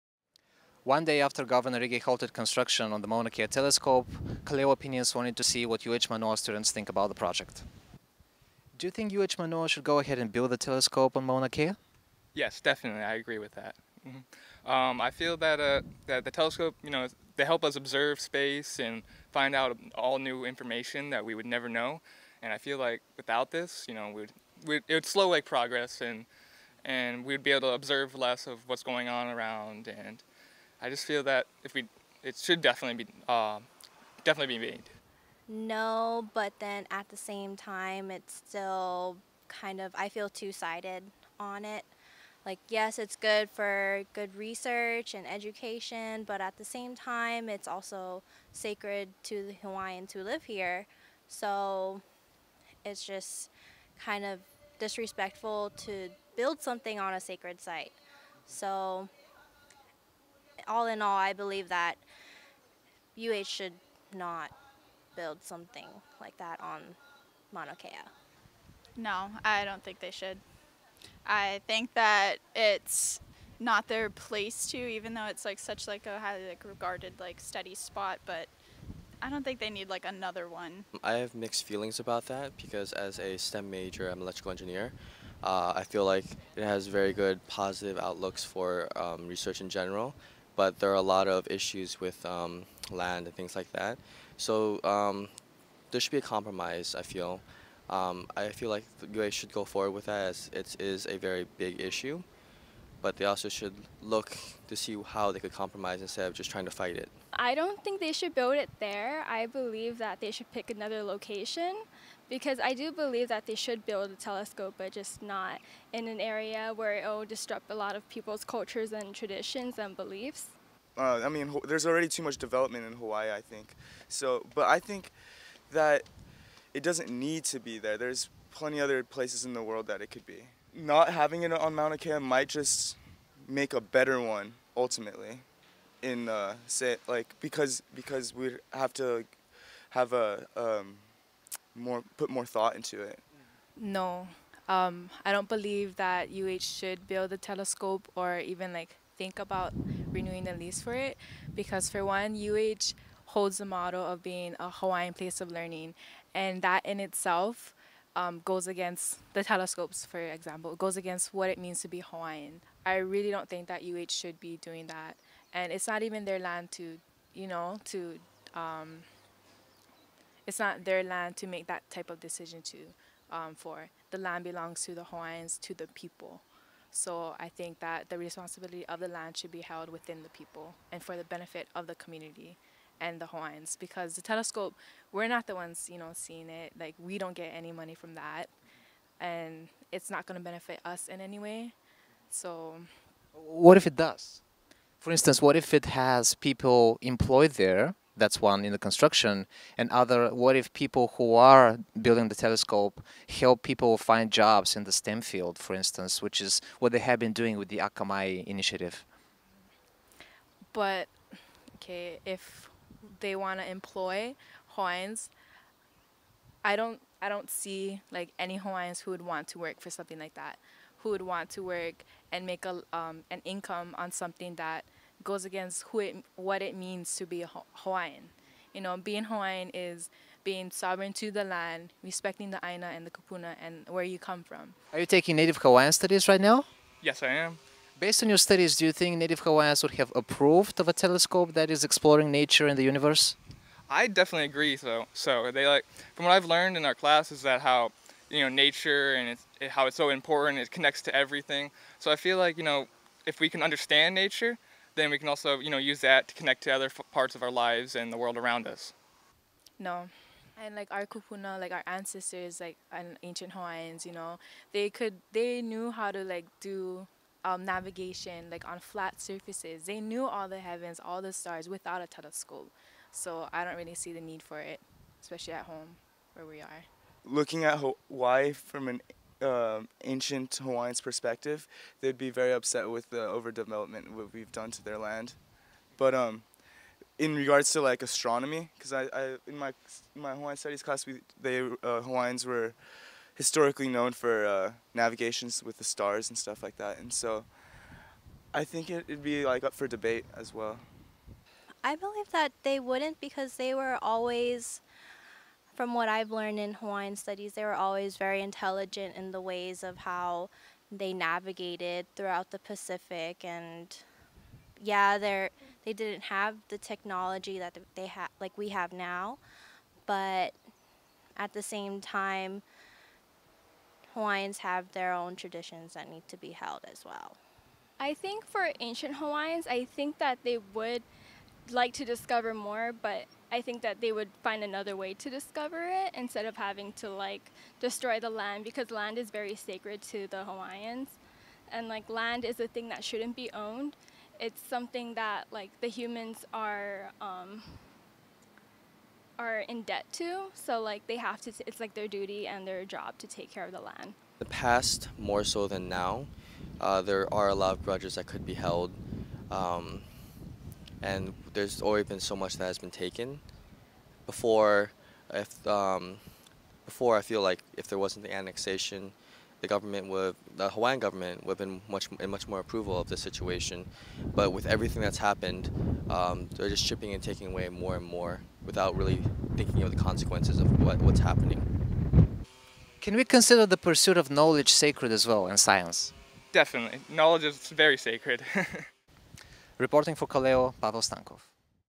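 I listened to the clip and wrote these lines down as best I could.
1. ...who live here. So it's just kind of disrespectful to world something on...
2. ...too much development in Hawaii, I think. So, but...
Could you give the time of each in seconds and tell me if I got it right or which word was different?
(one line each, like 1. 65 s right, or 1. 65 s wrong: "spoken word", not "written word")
1. 50 s wrong: "build", not "world"
2. 122 s right.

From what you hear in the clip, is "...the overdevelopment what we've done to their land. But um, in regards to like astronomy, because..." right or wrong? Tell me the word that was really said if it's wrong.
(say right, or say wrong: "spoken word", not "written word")
right.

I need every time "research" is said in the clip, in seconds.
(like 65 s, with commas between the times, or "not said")
44 s, 89 s.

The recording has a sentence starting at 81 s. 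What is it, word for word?
I have mixed feelings about that because as a STEM major, I'm an electrical engineer.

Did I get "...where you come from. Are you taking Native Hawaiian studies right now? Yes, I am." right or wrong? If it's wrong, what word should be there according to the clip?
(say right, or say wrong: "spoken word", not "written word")
right.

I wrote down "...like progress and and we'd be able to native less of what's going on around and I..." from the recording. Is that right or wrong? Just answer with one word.
wrong.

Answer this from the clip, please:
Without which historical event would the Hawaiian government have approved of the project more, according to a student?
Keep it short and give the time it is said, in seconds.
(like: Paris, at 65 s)
The annexation, at 368 s.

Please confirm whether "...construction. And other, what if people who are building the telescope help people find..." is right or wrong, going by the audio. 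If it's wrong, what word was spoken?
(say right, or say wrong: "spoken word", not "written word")
right.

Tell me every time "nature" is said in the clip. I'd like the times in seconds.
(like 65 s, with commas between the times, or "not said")
242 s, 248 s, 254 s.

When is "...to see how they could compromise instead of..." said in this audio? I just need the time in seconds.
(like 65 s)
104 s.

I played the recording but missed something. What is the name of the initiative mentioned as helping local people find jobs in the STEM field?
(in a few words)
Akamai initiative.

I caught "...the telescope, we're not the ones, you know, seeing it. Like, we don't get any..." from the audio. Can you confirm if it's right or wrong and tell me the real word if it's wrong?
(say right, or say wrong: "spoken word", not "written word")
right.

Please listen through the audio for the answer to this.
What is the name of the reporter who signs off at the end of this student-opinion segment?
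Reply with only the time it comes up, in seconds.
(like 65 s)
390 s.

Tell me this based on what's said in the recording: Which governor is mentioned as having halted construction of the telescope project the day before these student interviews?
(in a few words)
Governor Ige.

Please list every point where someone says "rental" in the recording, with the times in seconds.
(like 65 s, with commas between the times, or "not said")
not said.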